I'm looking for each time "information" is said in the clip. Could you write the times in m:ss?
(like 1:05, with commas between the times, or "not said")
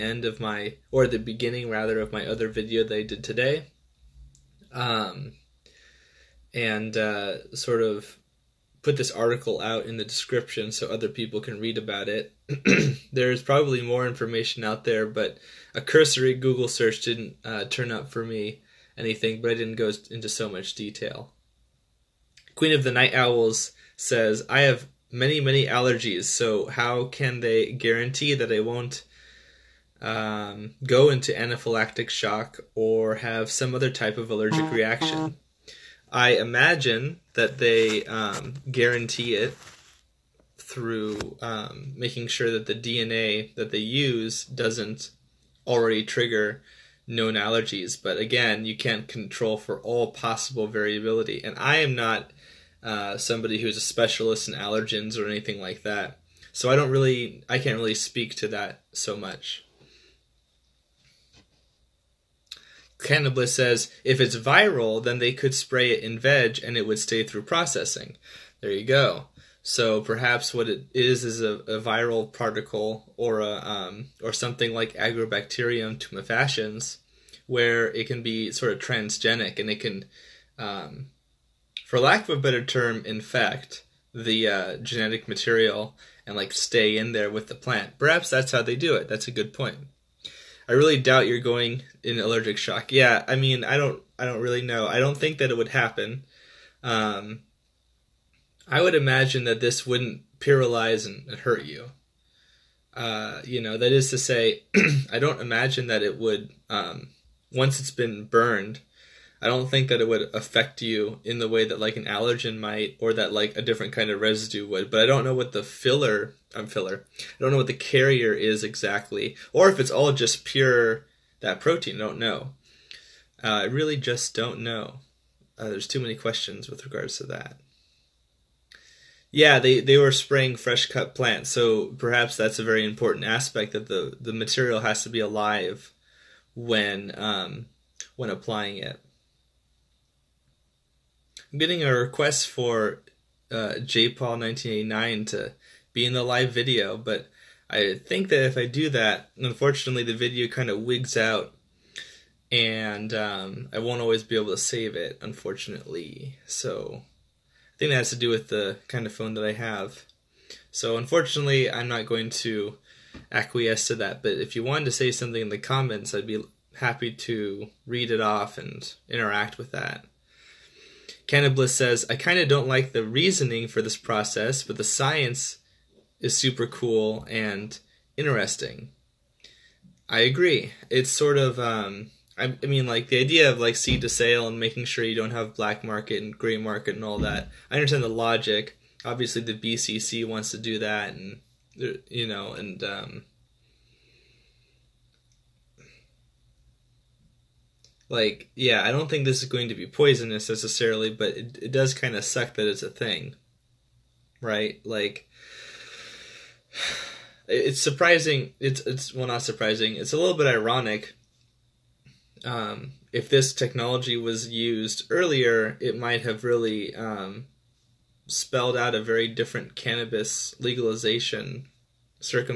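0:14.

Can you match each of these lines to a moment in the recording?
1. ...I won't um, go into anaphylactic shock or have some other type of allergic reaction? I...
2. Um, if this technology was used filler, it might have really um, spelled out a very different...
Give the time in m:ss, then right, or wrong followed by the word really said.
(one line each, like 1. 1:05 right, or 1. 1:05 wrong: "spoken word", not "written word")
1. 0:28 right
2. 3:32 wrong: "earlier", not "filler".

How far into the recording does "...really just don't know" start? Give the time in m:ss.
2:03.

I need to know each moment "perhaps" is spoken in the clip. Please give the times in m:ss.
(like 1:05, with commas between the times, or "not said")
1:10, 1:27, 2:11.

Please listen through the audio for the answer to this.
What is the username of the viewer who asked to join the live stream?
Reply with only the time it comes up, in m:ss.
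2:23.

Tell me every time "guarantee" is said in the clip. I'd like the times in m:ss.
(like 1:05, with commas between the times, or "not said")
0:27, 0:38.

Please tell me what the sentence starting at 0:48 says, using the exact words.
But again, you can't control for all possible variability.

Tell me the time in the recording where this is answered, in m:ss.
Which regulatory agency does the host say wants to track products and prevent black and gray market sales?
3:09.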